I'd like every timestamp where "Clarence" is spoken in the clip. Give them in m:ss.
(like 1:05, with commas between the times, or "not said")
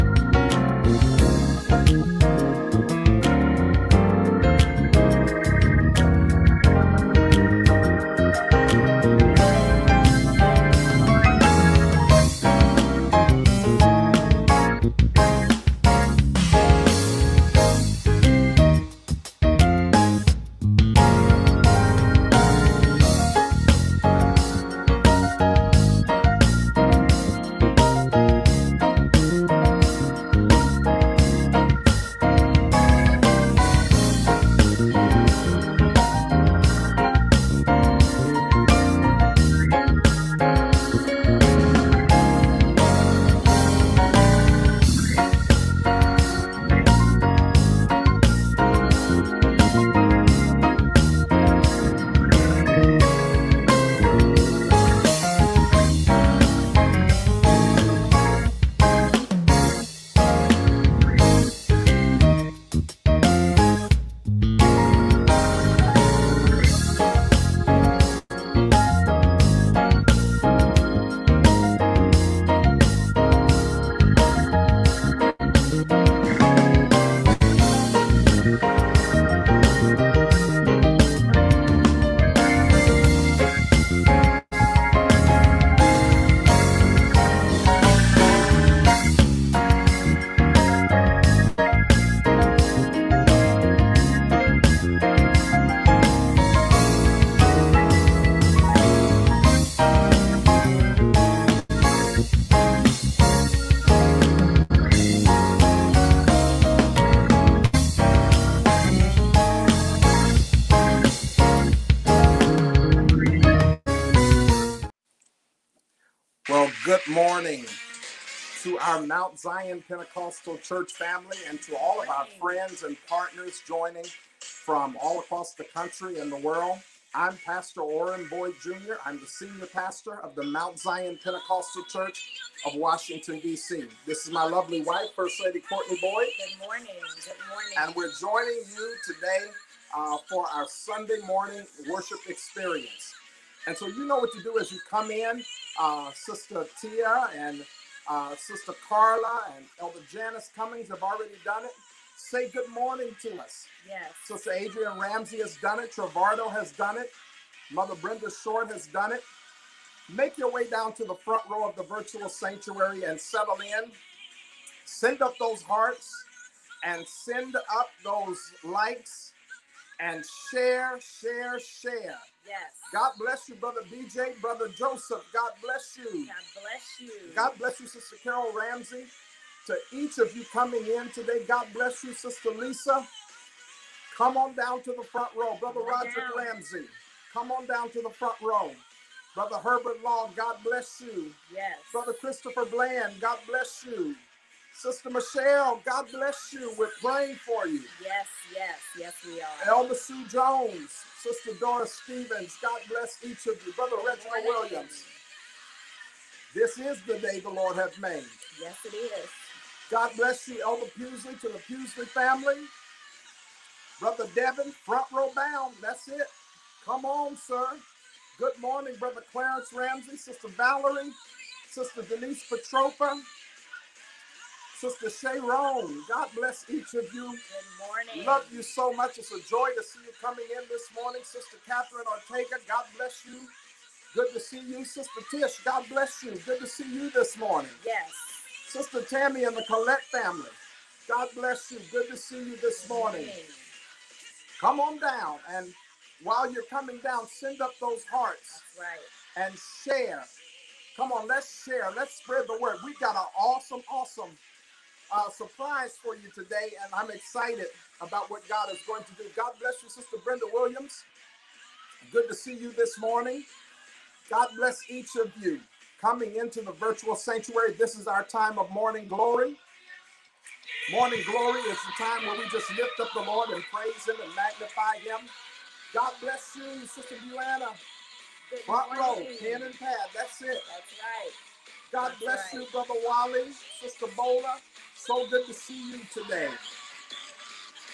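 3:39.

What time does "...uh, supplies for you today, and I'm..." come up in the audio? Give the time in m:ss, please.
4:15.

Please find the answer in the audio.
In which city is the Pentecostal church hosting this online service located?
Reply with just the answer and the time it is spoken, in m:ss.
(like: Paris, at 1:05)
Washington, D.C., at 2:12.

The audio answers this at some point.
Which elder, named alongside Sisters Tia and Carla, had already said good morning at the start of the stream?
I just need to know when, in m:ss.
2:30.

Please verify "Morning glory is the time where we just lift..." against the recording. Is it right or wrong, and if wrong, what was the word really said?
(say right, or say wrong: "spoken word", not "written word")
right.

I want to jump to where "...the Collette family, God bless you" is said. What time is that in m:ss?
3:59.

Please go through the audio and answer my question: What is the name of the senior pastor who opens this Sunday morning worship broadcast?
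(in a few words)
Orin Boyd Jr.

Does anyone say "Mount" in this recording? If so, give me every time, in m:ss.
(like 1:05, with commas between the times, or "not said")
1:59, 2:10.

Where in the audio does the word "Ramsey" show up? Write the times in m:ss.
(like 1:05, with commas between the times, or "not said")
2:34, 2:58, 3:06, 3:39.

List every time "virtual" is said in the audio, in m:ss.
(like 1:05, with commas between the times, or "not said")
2:41, 4:26.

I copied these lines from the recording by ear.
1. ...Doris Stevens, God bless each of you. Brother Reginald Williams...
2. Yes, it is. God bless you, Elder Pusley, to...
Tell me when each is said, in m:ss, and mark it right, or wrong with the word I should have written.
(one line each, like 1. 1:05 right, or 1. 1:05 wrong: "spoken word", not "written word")
1. 3:21 right
2. 3:28 right.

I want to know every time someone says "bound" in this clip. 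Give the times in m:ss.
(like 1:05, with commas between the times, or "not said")
3:35.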